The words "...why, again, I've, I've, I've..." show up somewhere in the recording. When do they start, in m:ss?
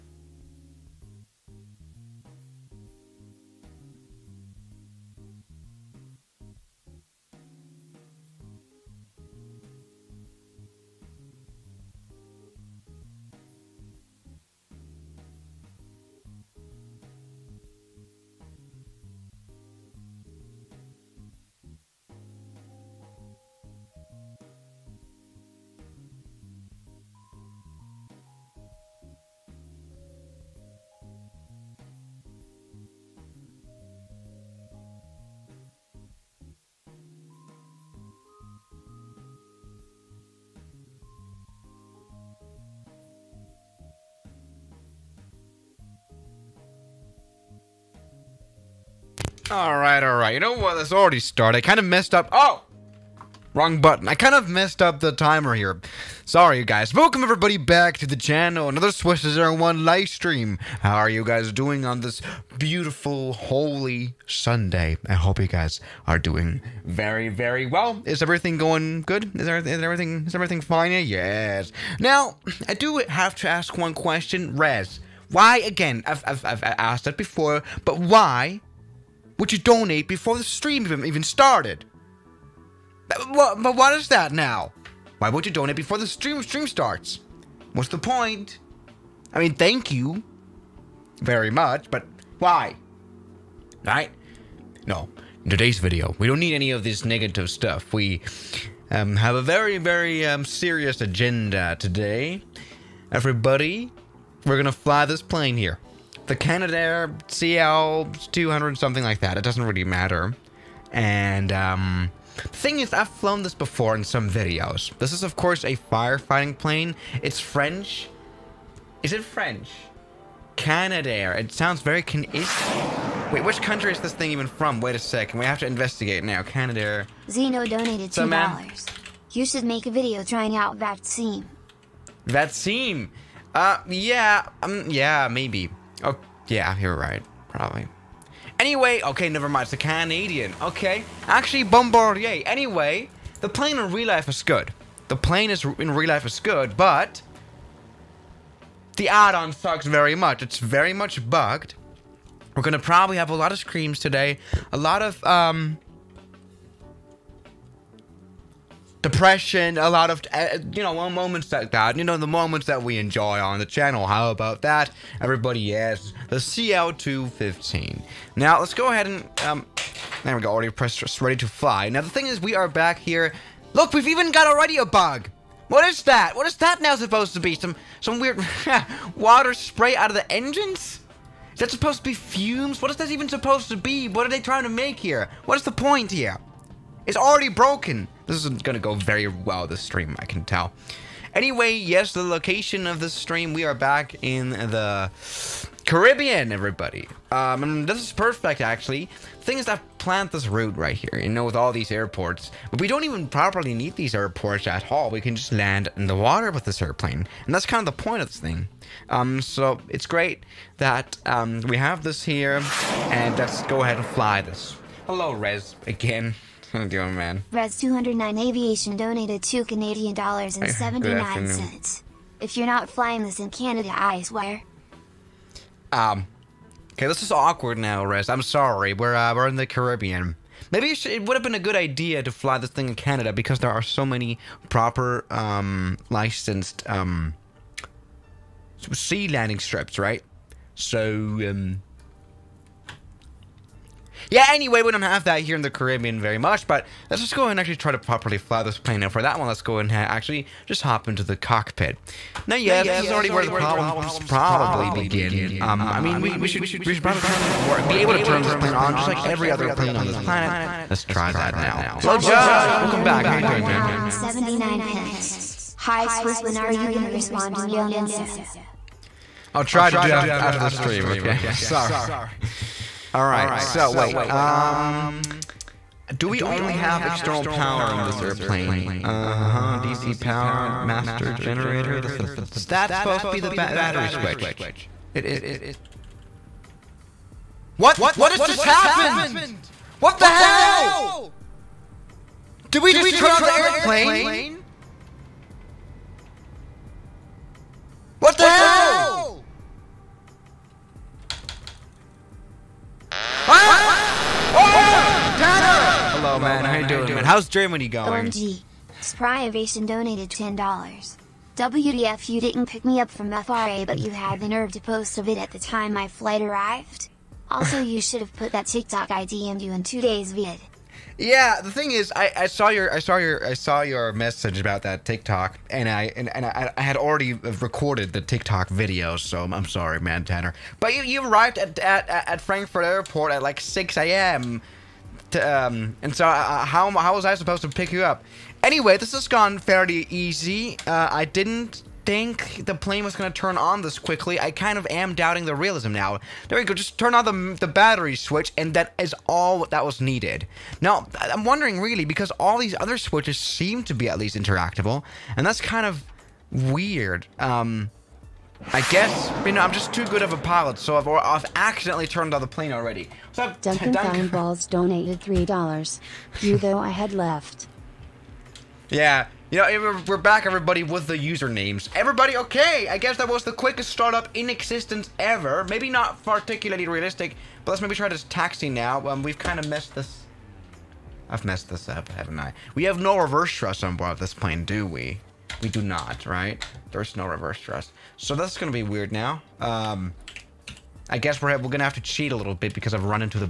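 1:15.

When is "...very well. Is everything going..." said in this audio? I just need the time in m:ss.
1:07.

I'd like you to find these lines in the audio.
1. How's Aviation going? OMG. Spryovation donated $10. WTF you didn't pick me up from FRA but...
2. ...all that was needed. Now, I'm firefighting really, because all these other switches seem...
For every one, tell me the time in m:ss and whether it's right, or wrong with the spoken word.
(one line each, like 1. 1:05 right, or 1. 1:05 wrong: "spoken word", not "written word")
1. 5:07 wrong: "Germany", not "Aviation"
2. 5:49 wrong: "wondering", not "firefighting".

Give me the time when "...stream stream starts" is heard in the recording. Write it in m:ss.
1:26.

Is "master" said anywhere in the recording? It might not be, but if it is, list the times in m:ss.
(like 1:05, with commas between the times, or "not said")
4:40.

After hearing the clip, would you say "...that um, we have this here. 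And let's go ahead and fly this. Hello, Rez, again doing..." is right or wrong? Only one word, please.
right.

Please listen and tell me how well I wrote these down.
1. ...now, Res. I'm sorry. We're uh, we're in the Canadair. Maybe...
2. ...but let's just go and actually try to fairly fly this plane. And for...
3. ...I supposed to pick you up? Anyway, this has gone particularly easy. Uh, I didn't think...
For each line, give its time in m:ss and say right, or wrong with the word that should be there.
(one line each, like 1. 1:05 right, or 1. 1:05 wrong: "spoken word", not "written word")
1. 3:47 wrong: "Caribbean", not "Canadair"
2. 4:06 wrong: "properly", not "fairly"
3. 5:37 wrong: "fairly", not "particularly".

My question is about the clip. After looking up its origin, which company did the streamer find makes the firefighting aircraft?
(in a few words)
Bombardier.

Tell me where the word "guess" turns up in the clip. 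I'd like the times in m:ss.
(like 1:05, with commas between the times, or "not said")
5:58, 6:12, 6:31.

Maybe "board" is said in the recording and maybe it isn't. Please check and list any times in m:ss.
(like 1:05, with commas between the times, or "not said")
6:23.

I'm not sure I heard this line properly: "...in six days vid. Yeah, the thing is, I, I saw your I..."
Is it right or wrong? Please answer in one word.
wrong.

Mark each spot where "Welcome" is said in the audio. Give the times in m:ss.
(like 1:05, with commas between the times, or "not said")
0:56, 4:22.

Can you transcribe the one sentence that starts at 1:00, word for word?
How are you guys doing on this beautiful, holy Sunday?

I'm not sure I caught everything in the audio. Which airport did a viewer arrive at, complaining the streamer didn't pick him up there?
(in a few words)
Frankfurt Airport.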